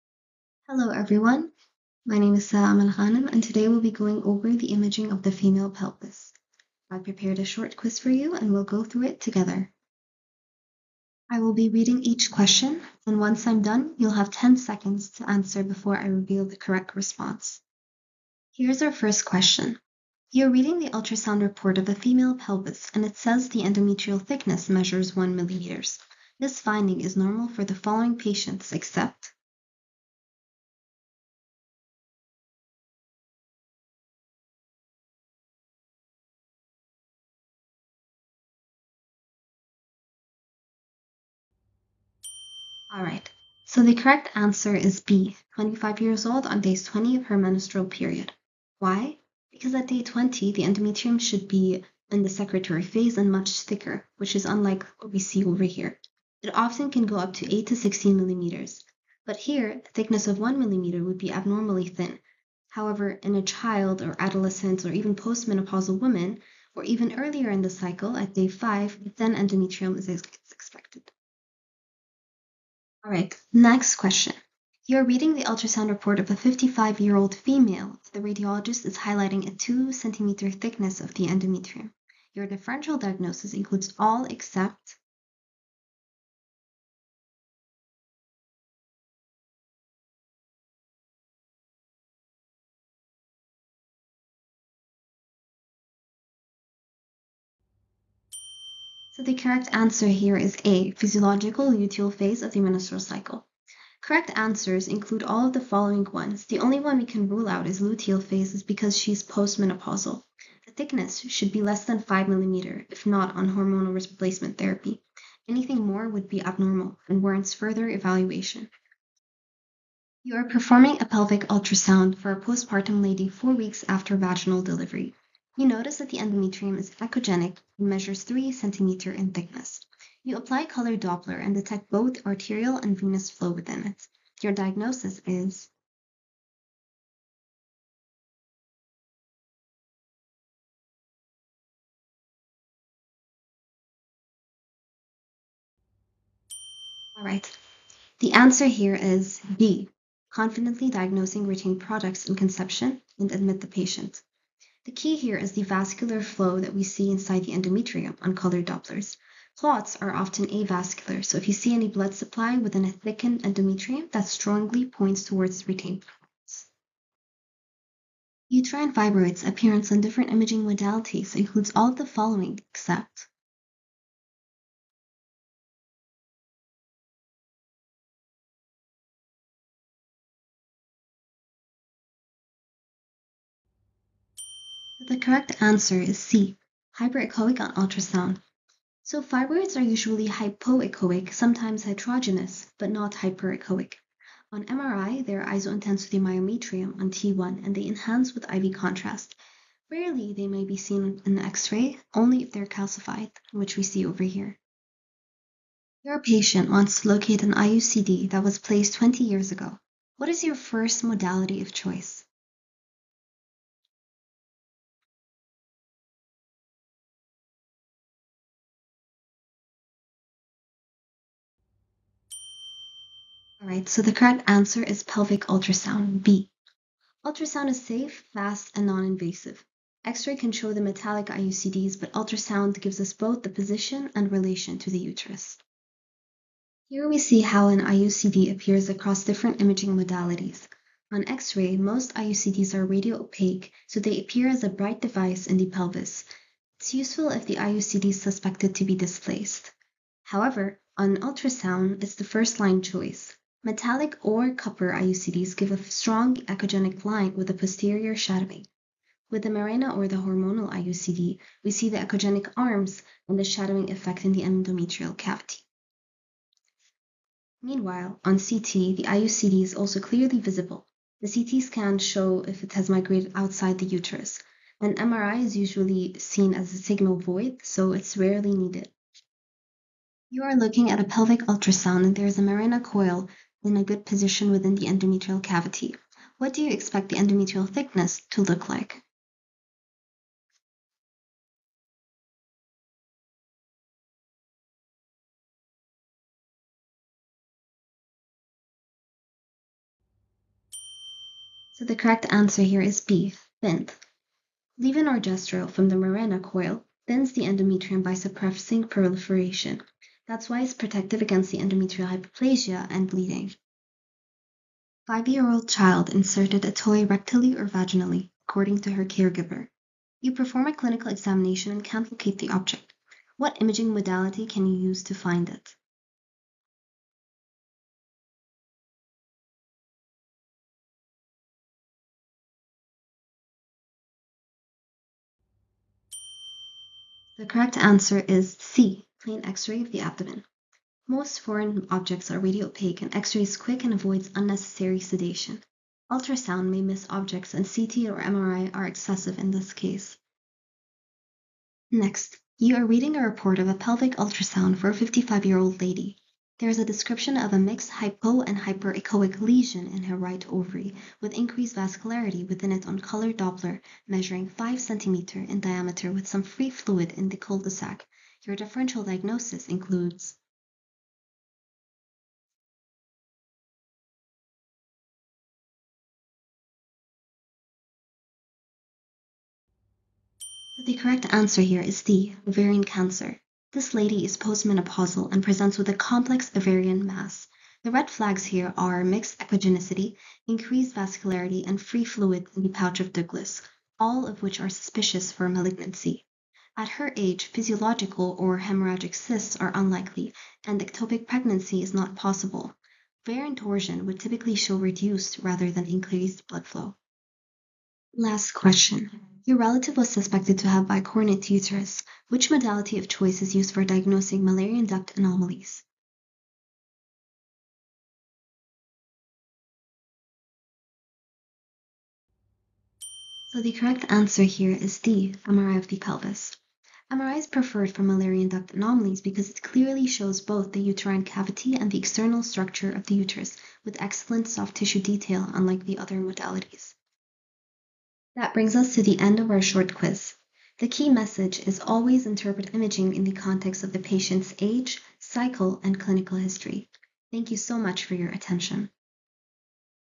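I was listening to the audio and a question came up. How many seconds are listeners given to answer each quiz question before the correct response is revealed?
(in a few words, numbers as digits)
10.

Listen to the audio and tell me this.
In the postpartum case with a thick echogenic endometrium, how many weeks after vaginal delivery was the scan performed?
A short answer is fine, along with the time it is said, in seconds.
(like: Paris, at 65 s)
4, at 123 s.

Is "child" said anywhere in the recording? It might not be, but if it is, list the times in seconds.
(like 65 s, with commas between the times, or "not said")
63 s, 315 s.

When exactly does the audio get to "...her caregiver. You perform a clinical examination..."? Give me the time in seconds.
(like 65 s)
318 s.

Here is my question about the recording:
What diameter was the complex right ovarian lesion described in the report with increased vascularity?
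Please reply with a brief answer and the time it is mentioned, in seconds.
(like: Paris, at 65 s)
5 cm, at 364 s.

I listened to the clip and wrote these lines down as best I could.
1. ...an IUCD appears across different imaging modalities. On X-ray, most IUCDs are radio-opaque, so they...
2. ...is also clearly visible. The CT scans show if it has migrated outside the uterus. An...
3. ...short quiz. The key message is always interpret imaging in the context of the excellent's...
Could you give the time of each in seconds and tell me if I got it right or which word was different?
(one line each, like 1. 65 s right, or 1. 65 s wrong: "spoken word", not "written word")
1. 237 s right
2. 269 s right
3. 439 s wrong: "patient", not "excellent".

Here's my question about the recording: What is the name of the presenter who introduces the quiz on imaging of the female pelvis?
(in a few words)
Salama Al Ghanim.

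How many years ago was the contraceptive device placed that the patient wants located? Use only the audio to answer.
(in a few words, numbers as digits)
20.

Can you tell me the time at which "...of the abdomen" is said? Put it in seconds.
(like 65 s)
339 s.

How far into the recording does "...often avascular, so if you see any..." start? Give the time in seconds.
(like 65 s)
160 s.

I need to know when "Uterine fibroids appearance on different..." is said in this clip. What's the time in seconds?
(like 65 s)
168 s.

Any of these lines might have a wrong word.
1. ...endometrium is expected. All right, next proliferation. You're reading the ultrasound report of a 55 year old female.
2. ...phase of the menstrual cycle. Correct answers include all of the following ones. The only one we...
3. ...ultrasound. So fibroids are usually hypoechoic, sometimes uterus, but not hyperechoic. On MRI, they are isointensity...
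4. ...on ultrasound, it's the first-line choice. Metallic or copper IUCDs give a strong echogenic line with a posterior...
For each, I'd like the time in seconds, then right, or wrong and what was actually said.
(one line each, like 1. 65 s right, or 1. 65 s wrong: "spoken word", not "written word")
1. 69 s wrong: "question", not "proliferation"
2. 102 s right
3. 187 s wrong: "heterogeneous", not "uterus"
4. 250 s right.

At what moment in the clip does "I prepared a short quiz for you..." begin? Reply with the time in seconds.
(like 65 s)
6 s.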